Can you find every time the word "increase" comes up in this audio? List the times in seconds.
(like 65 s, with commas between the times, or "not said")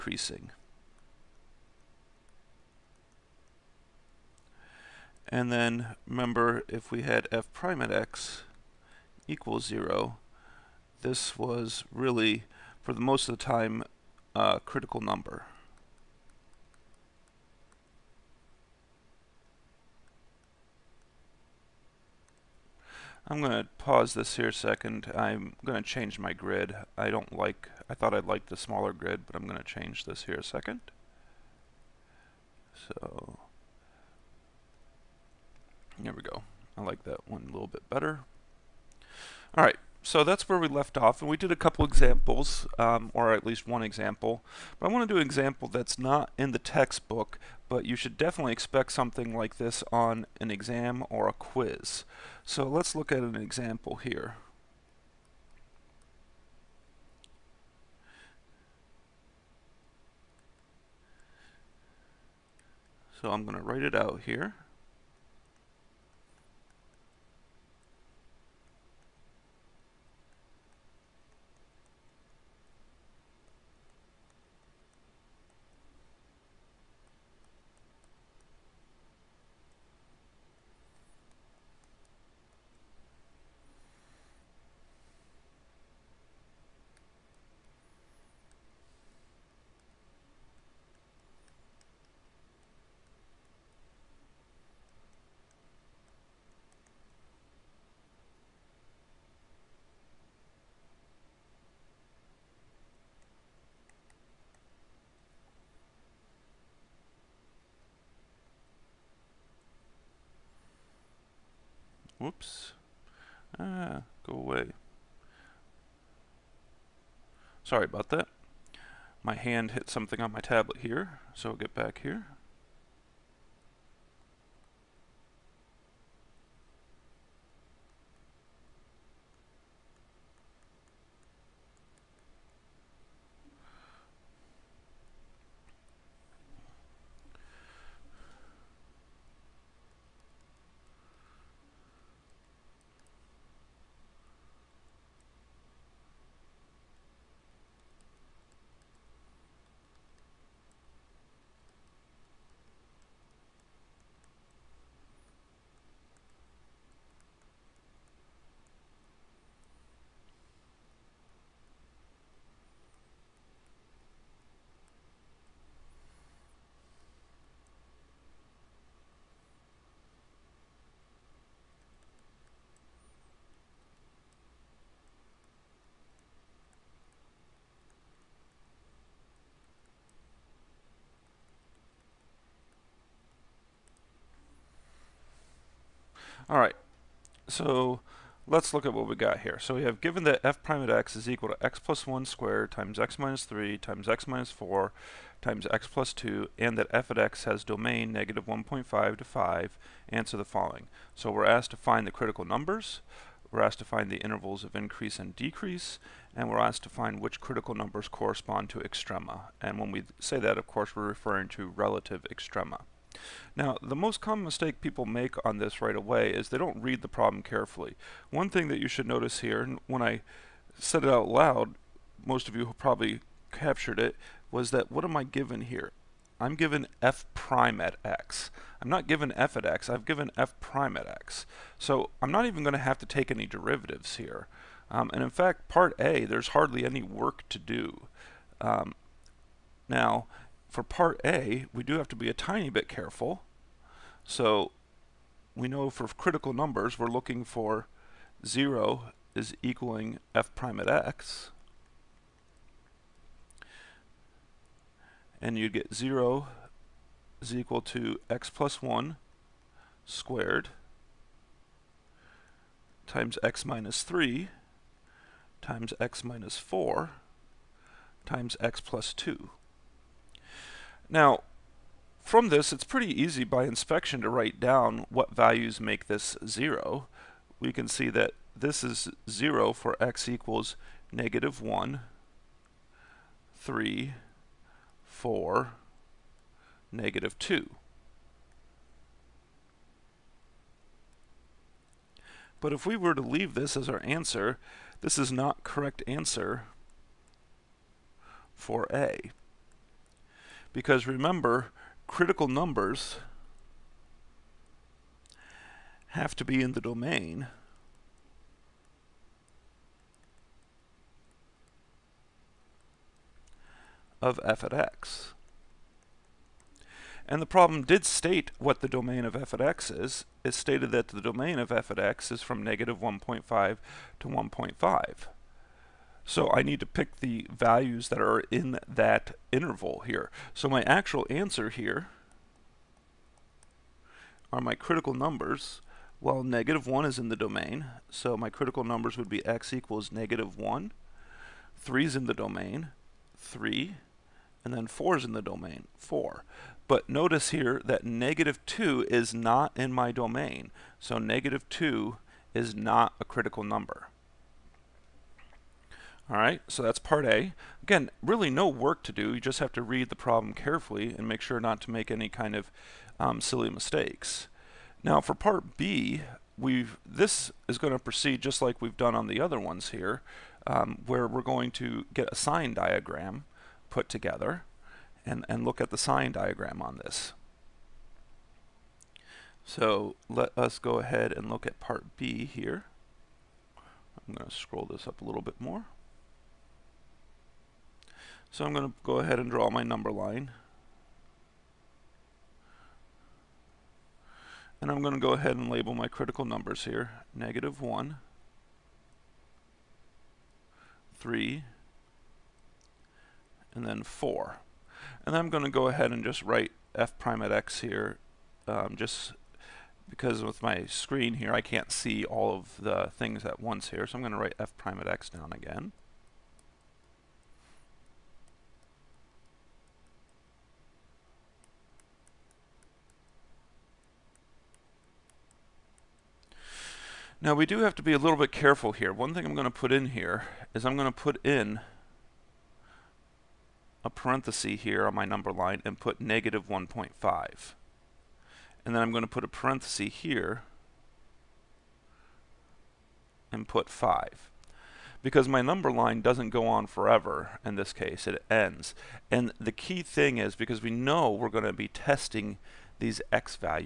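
204 s.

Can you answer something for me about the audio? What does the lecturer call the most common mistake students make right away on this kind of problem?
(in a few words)
don't read the problem carefully.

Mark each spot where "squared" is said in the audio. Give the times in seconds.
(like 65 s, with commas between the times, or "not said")
192 s, 260 s.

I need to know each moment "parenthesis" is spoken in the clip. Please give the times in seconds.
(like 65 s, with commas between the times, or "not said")
434 s, 439 s.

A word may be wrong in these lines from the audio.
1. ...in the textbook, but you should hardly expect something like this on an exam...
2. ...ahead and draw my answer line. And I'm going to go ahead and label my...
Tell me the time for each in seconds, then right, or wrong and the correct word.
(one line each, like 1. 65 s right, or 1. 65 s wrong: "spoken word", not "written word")
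1. 46 s wrong: "definitely", not "hardly"
2. 389 s wrong: "number", not "answer".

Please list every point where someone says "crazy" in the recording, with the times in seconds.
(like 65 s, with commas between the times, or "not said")
not said.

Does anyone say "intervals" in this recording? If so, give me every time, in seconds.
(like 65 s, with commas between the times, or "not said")
204 s, 329 s.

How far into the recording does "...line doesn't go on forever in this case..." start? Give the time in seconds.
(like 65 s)
445 s.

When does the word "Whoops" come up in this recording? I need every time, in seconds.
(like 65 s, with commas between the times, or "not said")
112 s.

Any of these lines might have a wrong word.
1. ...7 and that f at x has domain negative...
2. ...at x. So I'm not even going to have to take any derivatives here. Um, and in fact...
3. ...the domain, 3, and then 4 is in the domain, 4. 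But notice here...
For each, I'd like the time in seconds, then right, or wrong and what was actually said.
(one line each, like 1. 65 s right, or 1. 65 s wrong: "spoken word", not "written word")
1. 196 s wrong: "2", not "7"
2. 230 s right
3. 342 s right.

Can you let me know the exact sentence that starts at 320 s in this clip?
It stated that the domain of f at x is from negative 1.5 to 1.5.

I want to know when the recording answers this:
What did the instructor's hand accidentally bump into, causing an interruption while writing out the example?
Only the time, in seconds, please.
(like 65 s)
120 s.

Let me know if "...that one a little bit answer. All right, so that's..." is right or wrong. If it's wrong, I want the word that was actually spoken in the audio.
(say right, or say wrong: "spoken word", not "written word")
wrong: "better", not "answer".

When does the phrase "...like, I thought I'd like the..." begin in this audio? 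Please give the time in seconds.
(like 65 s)
27 s.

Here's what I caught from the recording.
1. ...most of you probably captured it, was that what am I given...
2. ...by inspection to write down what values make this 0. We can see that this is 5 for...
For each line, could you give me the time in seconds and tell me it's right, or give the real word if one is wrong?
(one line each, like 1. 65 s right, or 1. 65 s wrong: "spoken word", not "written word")
1. 222 s right
2. 273 s wrong: "0", not "5".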